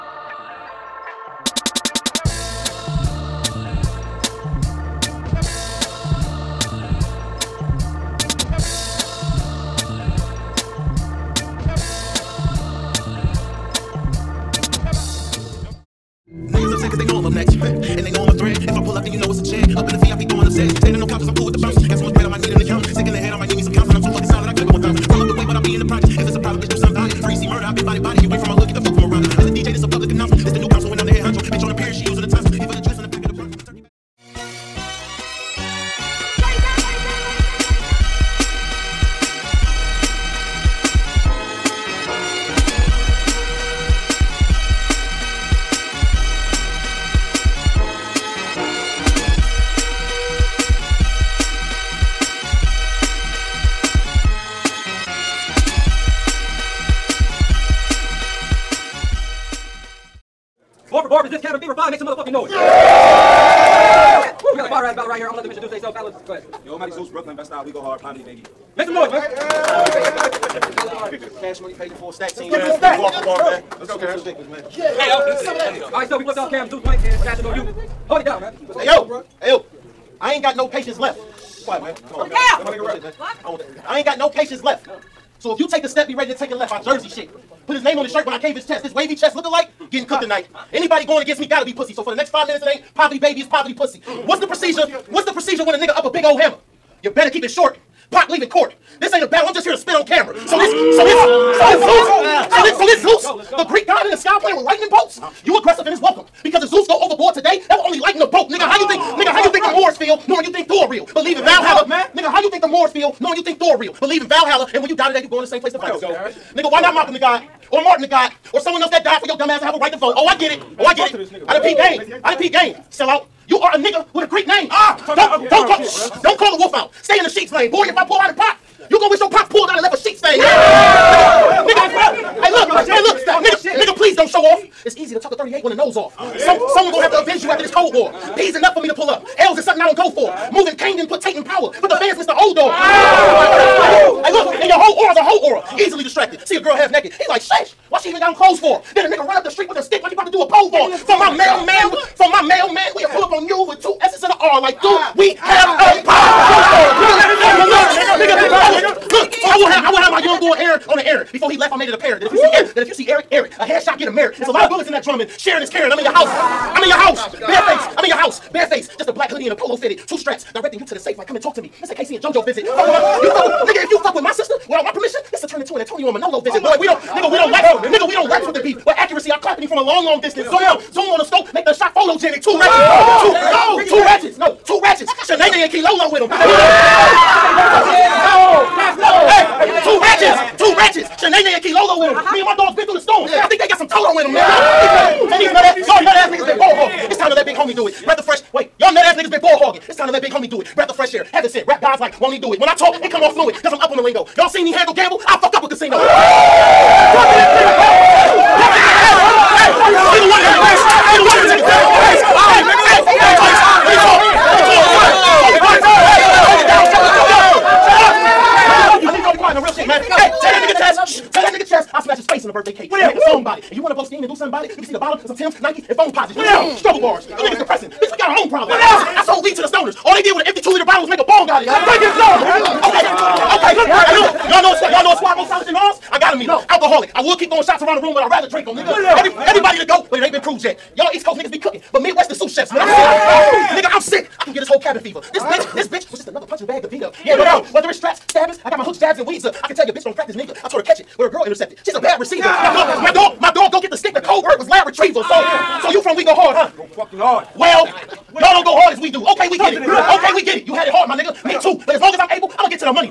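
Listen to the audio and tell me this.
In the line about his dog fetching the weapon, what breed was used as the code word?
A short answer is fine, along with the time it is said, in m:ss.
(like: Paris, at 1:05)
lab retriever, at 4:14.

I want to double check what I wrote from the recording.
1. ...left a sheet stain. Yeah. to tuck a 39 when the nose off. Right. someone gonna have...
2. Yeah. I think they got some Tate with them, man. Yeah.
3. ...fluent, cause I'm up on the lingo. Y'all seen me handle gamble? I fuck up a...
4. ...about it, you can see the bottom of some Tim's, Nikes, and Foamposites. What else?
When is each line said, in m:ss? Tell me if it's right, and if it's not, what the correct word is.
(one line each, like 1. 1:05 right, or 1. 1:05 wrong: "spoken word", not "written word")
1. 2:09 wrong: "38", not "39"
2. 3:13 wrong: "Toto", not "Tate"
3. 3:23 right
4. 3:44 right.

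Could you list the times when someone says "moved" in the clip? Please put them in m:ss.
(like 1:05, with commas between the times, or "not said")
not said.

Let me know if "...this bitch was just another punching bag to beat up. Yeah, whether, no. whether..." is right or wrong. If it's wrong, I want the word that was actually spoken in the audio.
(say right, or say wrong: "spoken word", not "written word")
right.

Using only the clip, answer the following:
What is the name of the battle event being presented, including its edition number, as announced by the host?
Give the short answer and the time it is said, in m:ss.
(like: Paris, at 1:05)
Cabin Fever 5, at 1:01.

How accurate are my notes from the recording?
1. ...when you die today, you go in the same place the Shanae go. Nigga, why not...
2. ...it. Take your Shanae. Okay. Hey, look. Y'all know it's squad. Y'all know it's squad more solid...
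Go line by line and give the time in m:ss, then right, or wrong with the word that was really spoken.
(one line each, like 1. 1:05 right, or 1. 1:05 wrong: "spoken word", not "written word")
1. 1:54 wrong: "Vikings", not "Shanae"
2. 3:51 wrong: "Okay", not "Shanae".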